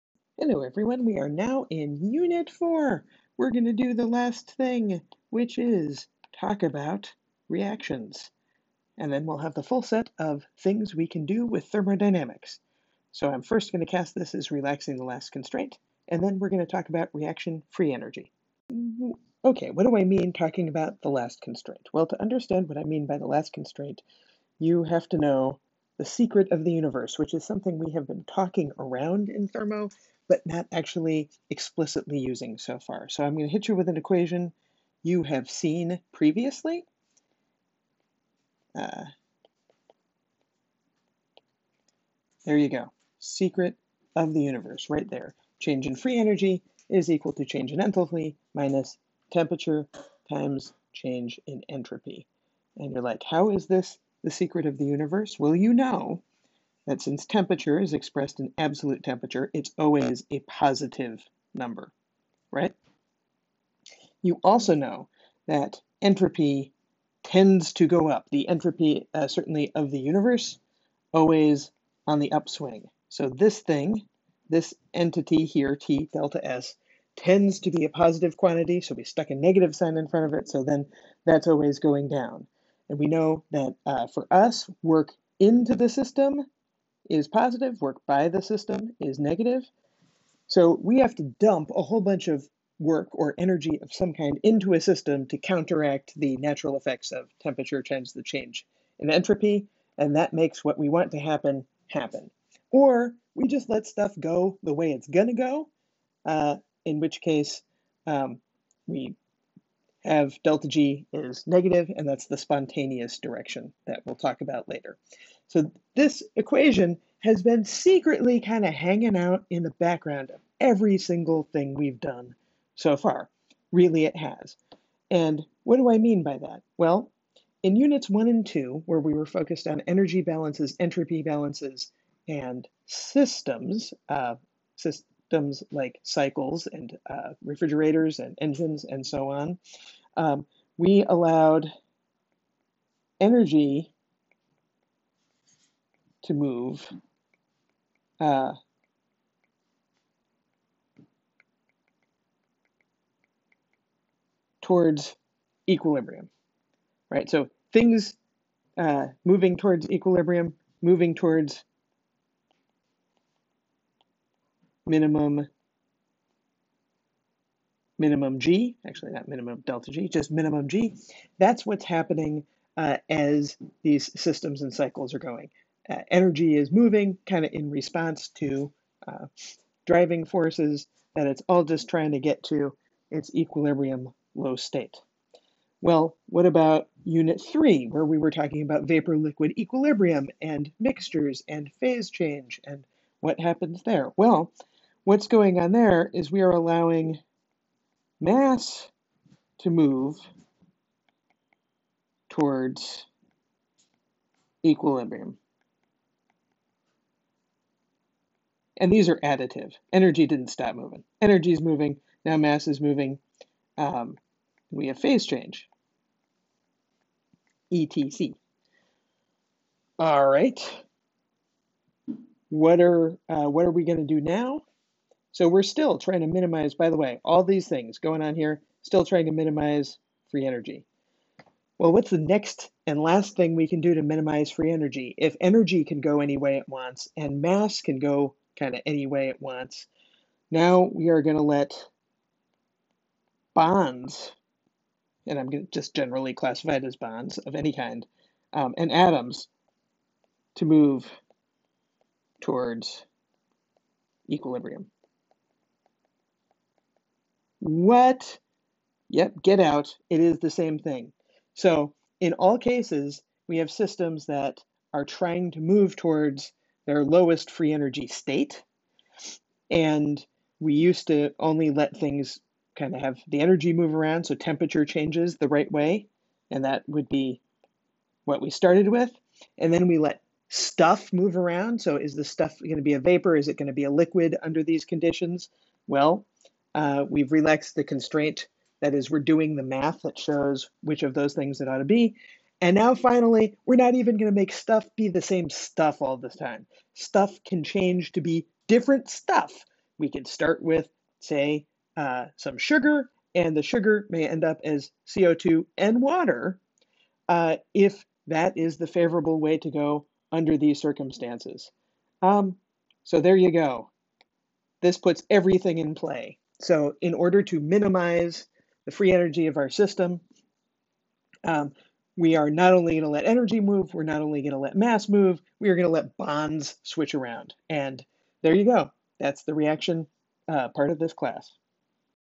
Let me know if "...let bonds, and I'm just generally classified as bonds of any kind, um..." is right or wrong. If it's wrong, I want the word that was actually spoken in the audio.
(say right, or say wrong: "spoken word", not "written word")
right.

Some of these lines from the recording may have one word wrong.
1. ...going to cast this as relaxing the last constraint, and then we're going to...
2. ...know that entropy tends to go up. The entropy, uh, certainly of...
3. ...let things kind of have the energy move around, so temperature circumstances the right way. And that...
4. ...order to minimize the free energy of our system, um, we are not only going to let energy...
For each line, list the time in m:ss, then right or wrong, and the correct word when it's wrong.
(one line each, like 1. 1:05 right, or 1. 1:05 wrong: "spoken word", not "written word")
1. 0:13 right
2. 1:04 right
3. 4:31 wrong: "changes", not "circumstances"
4. 5:17 right.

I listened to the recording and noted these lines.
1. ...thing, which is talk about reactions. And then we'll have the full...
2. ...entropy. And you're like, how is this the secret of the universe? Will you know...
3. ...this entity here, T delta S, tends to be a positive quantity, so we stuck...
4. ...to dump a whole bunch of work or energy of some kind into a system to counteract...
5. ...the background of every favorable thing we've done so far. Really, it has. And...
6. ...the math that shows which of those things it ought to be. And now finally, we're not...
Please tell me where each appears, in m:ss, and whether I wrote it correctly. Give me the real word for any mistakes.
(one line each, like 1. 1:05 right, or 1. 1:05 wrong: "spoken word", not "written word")
1. 0:04 right
2. 0:51 right
3. 1:14 right
4. 1:31 right
5. 1:59 wrong: "single", not "favorable"
6. 4:49 right.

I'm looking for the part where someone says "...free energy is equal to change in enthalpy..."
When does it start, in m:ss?
0:45.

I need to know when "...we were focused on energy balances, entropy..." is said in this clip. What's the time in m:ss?
2:08.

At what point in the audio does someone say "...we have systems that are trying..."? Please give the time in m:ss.
4:23.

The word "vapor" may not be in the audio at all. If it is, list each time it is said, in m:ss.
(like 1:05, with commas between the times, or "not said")
3:08, 4:42.